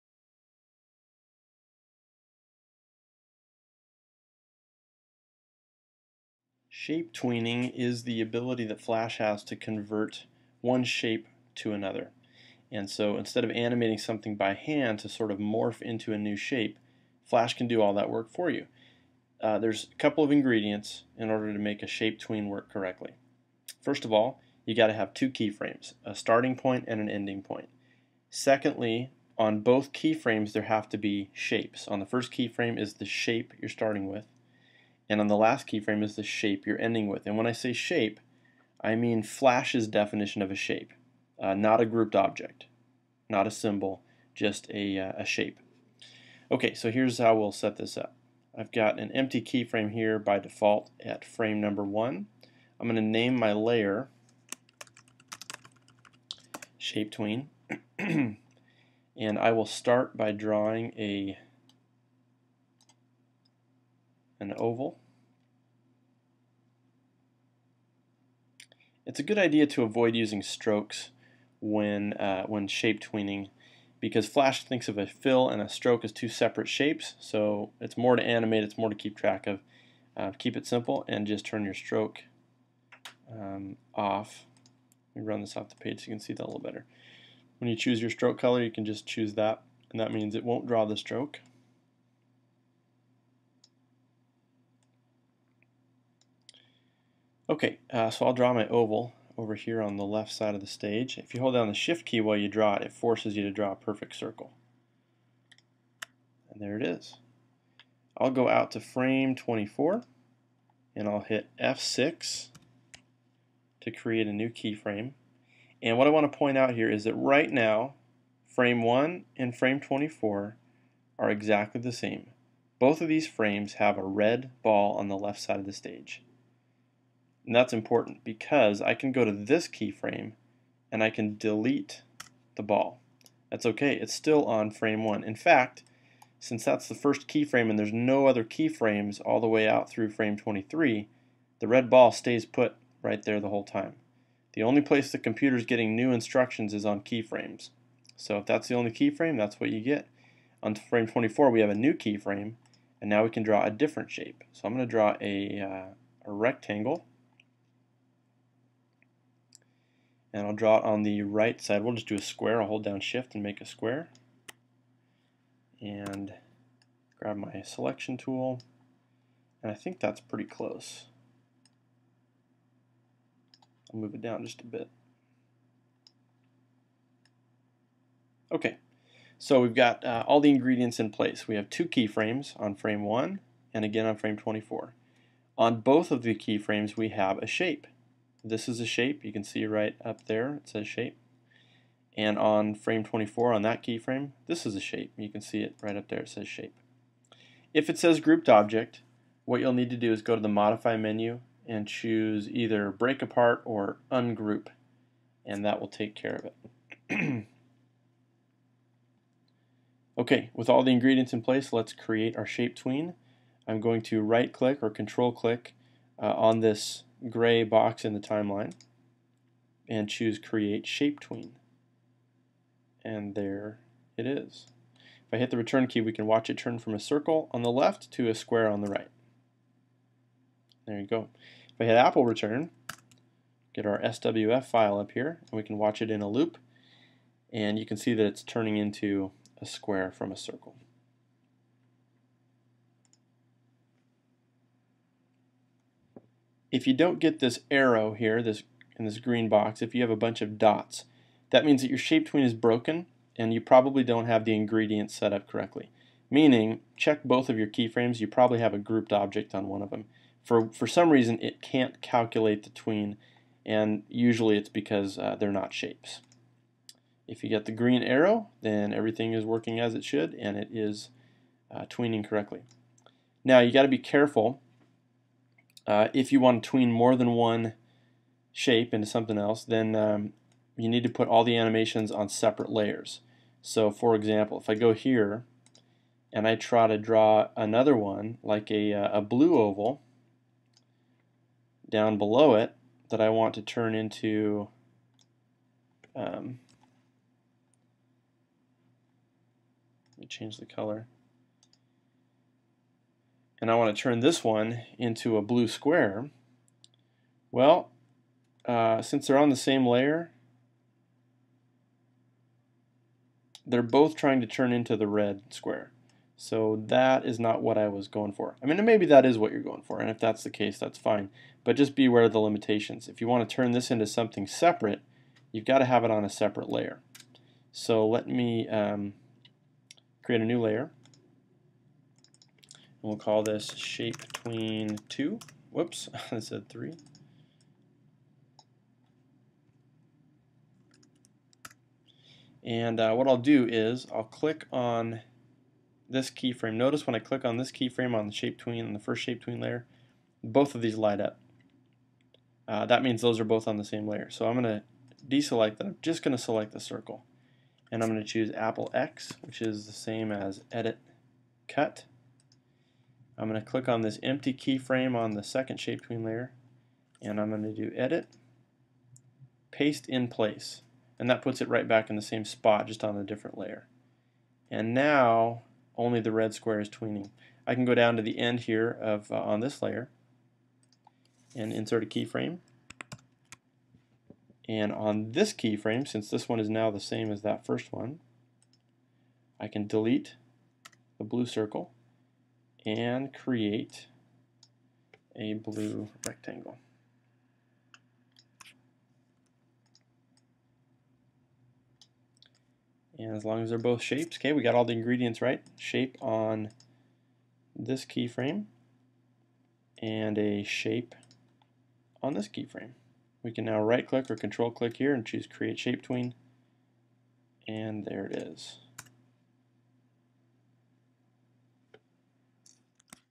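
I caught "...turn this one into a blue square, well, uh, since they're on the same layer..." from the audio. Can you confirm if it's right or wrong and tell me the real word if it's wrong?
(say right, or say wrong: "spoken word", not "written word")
right.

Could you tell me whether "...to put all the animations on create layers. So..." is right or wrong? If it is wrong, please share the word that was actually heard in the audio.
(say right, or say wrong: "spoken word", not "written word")
wrong: "separate", not "create".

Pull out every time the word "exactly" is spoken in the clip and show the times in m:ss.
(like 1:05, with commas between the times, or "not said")
2:01.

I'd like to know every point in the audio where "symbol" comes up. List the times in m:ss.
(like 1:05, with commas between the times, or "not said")
0:43.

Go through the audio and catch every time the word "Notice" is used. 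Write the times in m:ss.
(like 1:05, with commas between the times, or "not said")
5:46.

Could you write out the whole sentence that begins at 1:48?
I'll go out to frame 24 and I'll hit F6 to create a new keyframe.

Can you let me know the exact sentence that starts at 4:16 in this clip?
Meaning, check both of your keyframes, you probably have a grouped object on one of them.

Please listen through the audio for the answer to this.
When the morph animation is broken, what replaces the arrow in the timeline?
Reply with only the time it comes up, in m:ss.
4:10.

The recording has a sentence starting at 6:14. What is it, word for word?
And now only the red square is tweening.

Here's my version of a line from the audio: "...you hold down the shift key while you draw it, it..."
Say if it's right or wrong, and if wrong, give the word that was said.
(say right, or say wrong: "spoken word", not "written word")
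right.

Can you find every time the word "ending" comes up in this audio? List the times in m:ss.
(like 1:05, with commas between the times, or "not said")
0:27, 0:36.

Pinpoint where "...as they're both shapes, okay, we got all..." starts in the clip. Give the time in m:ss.
6:43.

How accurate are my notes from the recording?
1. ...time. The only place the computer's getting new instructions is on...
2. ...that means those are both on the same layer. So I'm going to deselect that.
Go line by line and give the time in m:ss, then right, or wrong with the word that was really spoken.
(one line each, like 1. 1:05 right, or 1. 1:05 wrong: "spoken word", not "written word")
1. 2:23 right
2. 5:52 right.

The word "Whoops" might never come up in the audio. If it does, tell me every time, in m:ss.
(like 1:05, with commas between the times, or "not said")
5:35.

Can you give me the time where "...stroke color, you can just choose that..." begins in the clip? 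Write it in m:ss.
1:28.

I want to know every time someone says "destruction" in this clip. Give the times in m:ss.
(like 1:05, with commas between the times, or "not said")
not said.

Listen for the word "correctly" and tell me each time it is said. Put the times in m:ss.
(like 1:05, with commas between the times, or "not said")
0:22, 4:15, 4:32.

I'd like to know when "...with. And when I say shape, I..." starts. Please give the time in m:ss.
0:37.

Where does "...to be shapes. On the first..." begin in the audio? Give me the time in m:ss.
0:30.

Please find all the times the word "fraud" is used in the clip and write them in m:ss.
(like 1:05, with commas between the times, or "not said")
not said.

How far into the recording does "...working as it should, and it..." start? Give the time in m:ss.
4:29.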